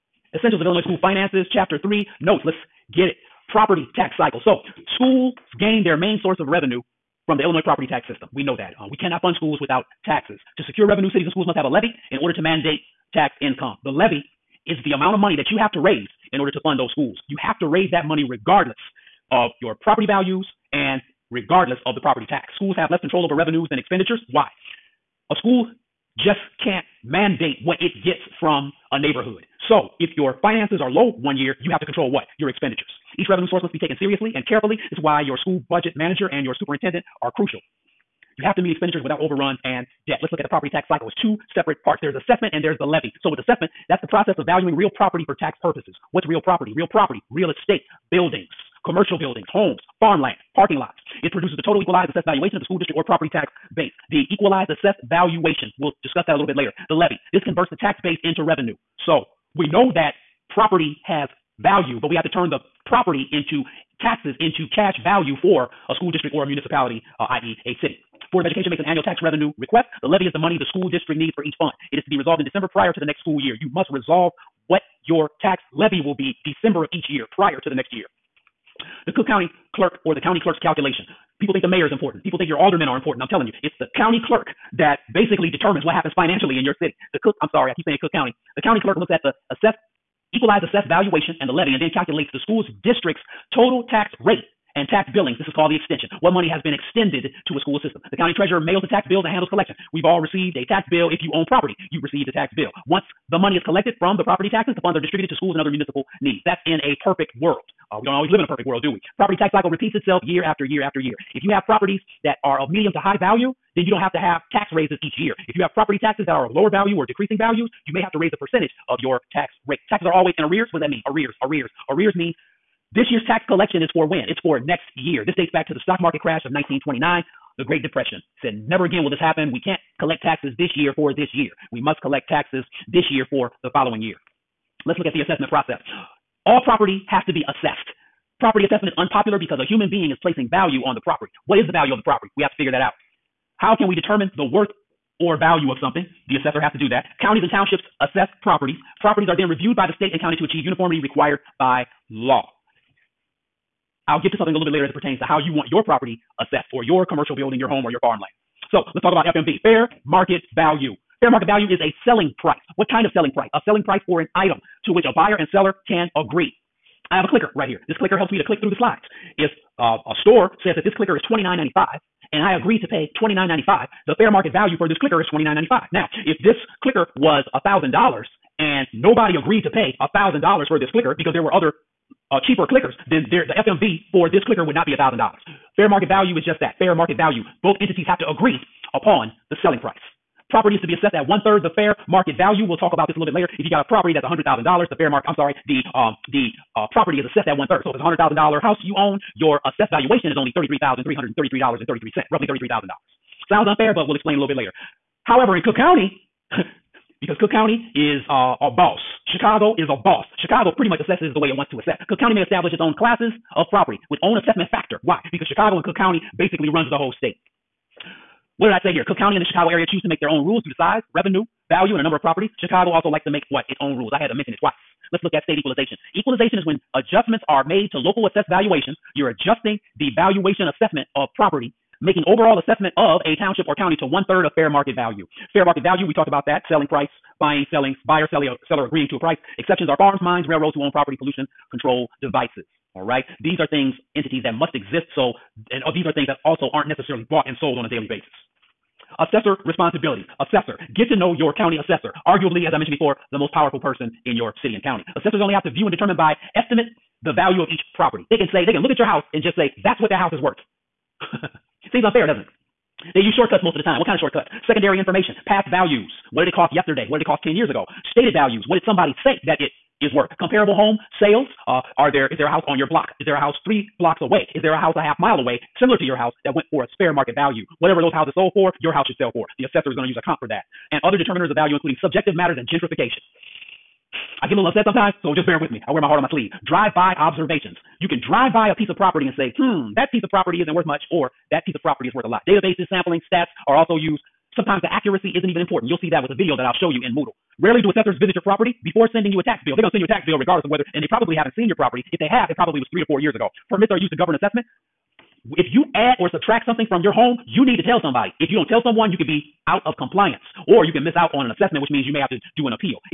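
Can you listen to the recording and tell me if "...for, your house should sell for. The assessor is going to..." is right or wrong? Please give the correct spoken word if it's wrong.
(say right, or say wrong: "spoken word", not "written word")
right.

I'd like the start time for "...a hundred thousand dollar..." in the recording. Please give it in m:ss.
3:17.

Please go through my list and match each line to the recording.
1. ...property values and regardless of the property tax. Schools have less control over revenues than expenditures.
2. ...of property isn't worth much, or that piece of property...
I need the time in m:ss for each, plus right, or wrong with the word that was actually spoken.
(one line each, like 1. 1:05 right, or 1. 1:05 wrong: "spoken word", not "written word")
1. 0:19 right
2. 4:50 right.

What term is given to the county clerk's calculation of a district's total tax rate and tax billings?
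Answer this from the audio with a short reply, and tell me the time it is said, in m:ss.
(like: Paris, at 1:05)
The extension, at 1:35.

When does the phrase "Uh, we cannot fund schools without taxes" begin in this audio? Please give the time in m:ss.
0:08.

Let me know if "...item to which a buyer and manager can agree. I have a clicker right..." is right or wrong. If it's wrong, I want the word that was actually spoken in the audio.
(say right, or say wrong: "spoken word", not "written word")
wrong: "seller", not "manager".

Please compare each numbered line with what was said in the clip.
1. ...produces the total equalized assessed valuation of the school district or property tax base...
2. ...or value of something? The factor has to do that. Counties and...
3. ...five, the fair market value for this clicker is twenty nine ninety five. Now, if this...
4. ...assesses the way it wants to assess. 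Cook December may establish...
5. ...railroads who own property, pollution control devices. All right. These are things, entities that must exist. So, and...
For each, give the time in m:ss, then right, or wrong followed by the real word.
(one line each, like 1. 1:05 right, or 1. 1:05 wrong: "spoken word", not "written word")
1. 0:51 right
2. 2:25 wrong: "assessor", not "factor"
3. 2:53 right
4. 3:30 wrong: "County", not "December"
5. 4:00 right.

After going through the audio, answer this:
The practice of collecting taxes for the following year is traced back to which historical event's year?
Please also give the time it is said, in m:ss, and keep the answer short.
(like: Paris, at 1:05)
1929, at 2:05.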